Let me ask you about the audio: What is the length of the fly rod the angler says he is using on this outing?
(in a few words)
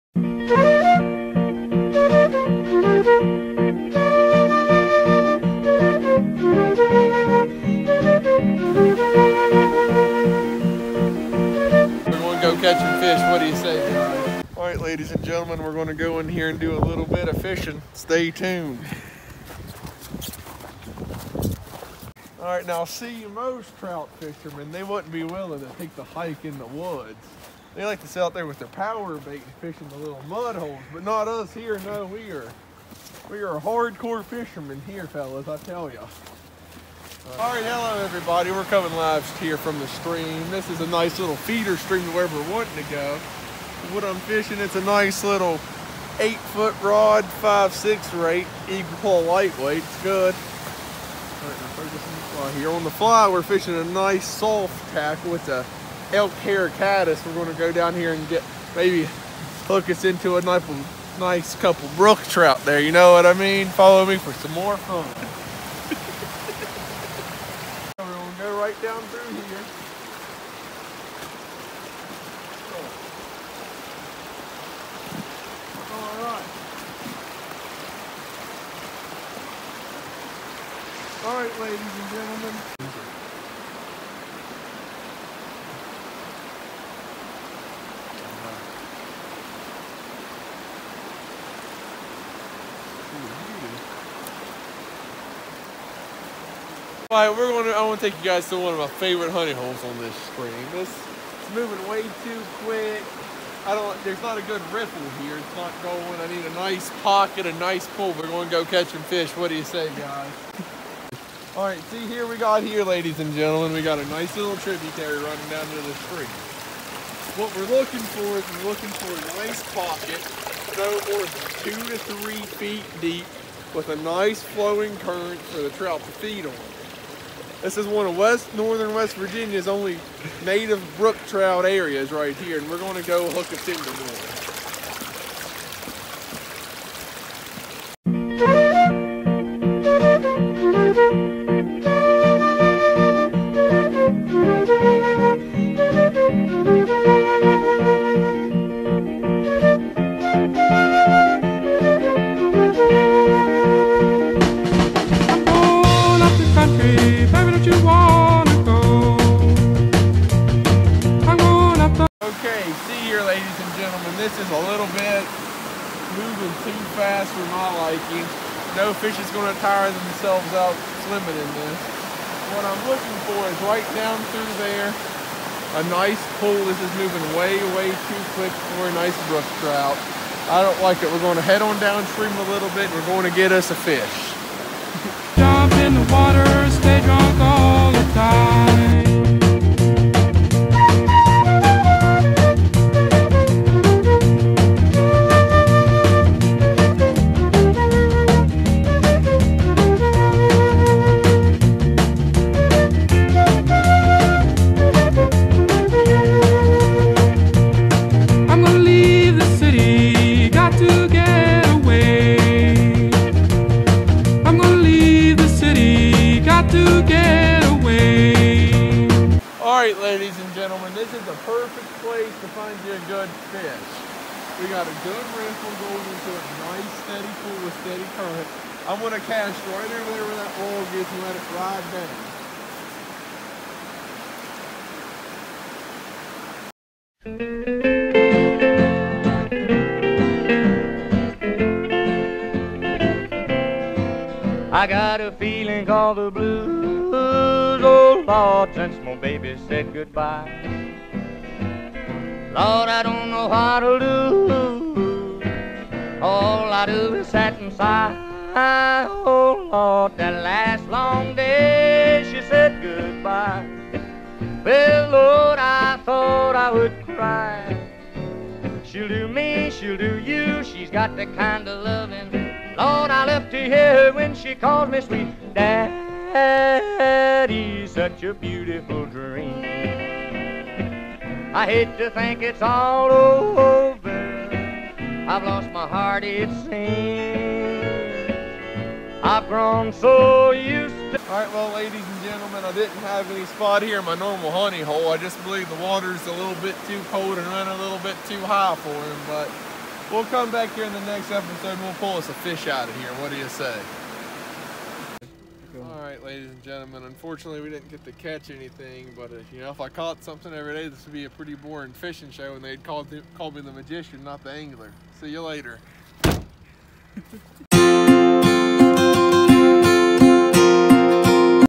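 8 foot.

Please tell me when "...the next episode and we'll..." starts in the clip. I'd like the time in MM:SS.
05:00.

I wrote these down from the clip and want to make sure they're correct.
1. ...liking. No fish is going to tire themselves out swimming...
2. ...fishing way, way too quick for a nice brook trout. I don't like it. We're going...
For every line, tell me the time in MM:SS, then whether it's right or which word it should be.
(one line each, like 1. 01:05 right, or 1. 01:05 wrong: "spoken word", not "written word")
1. 02:47 right
2. 02:56 wrong: "moving", not "fishing".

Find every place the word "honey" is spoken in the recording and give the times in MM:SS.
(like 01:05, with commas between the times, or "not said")
01:39, 04:54.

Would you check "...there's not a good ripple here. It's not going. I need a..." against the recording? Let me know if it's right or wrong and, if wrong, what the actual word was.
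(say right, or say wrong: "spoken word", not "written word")
right.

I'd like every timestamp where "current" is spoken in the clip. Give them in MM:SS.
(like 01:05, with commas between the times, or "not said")
02:05, 03:48.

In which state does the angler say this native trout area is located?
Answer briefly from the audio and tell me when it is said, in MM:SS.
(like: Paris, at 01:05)
West Virginia, at 02:08.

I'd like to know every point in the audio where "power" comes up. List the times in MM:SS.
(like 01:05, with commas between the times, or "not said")
00:28.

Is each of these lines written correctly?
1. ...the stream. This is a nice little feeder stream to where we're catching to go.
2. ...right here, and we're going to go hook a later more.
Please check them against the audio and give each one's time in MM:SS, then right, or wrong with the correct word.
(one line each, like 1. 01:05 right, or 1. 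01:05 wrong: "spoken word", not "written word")
1. 00:39 wrong: "wanting", not "catching"
2. 02:12 wrong: "timber", not "later".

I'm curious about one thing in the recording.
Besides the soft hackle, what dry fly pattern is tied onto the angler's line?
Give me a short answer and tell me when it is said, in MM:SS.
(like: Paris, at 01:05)
elk hair caddis, at 00:56.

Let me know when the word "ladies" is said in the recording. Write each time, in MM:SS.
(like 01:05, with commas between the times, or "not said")
00:14, 01:21, 01:52, 02:43, 04:51, 05:06.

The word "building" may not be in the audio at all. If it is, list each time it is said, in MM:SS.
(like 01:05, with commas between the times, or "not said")
not said.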